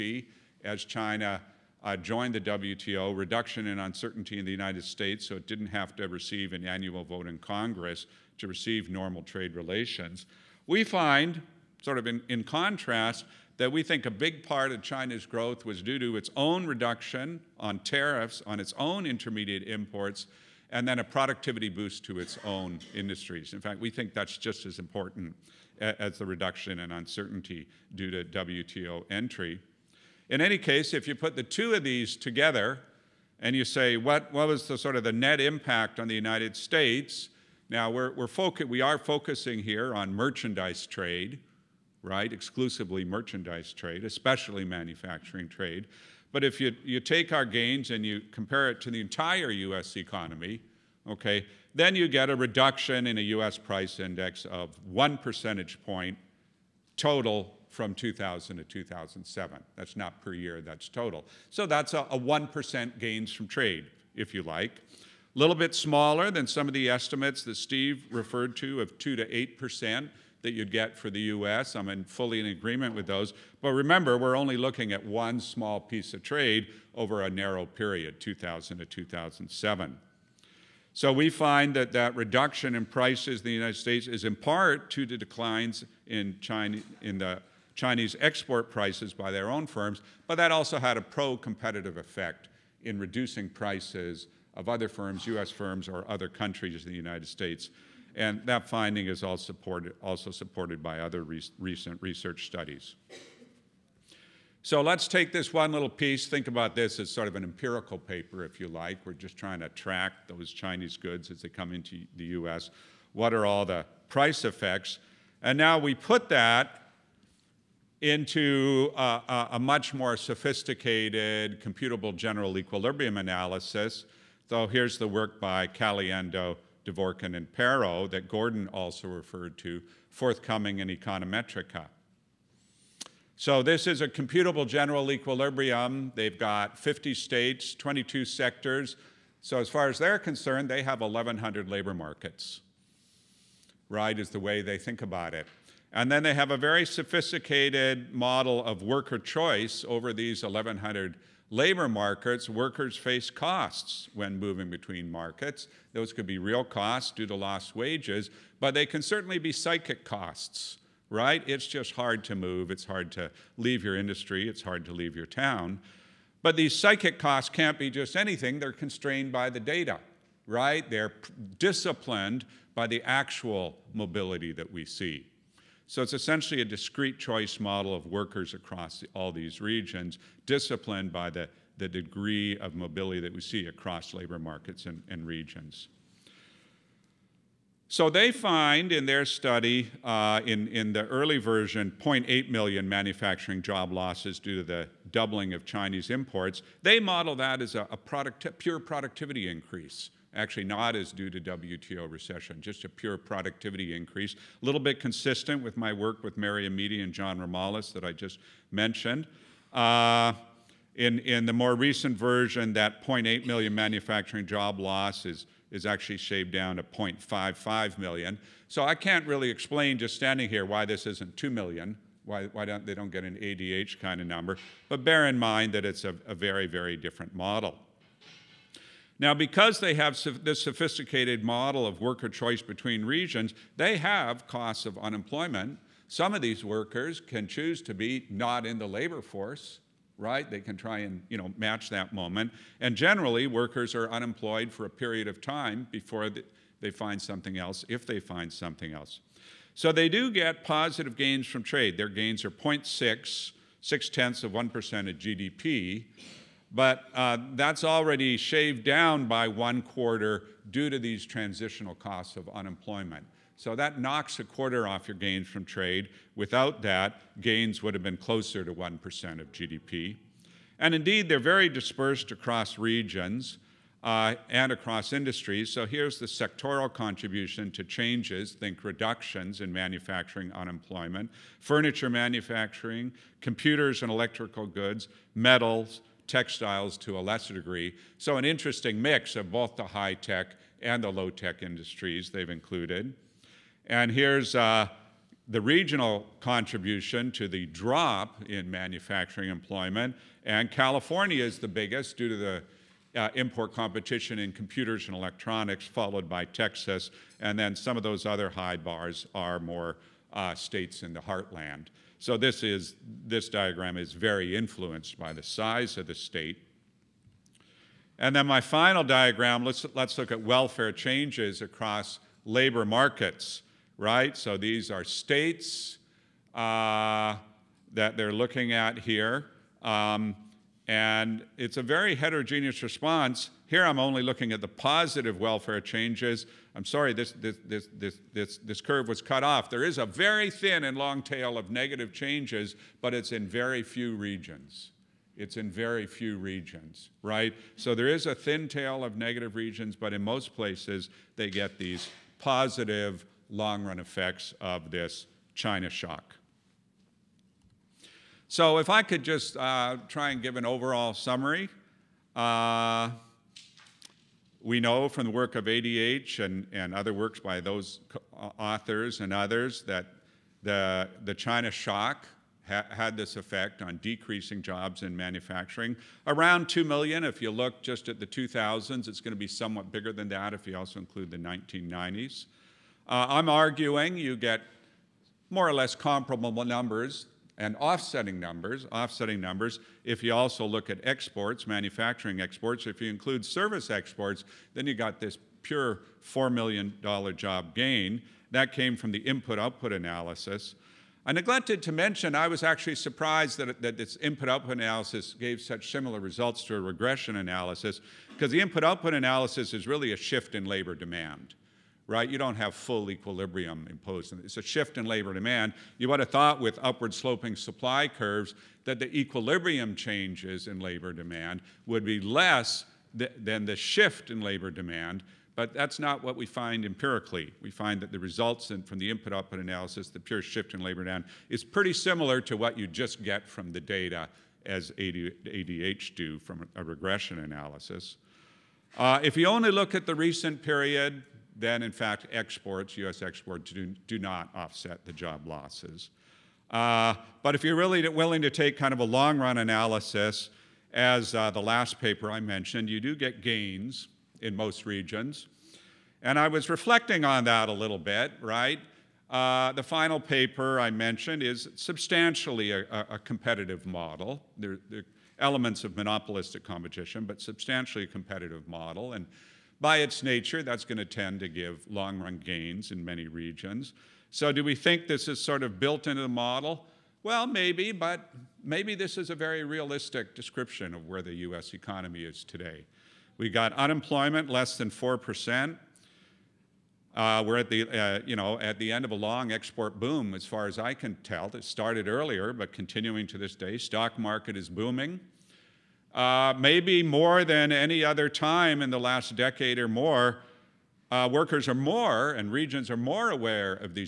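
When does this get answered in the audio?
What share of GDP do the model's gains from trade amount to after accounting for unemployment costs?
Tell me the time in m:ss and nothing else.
4:12.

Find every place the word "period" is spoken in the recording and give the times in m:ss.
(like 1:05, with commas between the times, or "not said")
1:17, 4:04, 7:20.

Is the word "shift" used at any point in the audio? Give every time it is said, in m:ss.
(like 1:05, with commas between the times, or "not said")
6:50, 6:54, 7:03, 7:10.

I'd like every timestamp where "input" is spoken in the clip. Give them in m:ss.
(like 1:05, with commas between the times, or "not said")
6:39, 6:44, 6:48, 7:09.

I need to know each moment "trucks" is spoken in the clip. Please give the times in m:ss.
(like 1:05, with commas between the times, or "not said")
not said.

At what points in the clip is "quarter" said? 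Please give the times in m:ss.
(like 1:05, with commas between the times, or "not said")
4:19, 4:24.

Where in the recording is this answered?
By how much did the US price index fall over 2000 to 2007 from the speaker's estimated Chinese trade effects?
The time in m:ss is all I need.
0:54.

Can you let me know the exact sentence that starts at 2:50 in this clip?
They're disciplined by the actual mobility that we see.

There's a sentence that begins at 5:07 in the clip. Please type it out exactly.
And then some of those other high bars are more uh, states in the heartland.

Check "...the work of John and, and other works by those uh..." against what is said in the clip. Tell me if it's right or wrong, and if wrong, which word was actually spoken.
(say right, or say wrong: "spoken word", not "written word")
wrong: "ADH", not "John".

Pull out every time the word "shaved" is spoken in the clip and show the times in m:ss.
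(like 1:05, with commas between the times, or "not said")
3:36, 4:18.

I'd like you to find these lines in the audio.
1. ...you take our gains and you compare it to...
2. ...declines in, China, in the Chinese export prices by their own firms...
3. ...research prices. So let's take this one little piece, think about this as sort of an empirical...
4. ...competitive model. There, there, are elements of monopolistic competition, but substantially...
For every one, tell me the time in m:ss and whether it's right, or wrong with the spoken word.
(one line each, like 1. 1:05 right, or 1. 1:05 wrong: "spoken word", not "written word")
1. 0:46 right
2. 1:25 right
3. 1:42 wrong: "studies", not "prices"
4. 7:43 right.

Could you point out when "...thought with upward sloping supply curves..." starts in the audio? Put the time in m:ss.
6:56.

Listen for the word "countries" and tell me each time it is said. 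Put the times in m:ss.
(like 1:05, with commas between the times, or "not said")
1:36.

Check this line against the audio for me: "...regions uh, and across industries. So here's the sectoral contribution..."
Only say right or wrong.
right.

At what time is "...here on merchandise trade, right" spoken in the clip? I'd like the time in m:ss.
0:39.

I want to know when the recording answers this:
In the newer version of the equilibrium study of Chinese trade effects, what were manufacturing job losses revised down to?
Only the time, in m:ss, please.
3:36.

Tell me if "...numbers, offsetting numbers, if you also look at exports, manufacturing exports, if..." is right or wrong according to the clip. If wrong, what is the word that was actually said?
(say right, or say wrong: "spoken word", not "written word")
right.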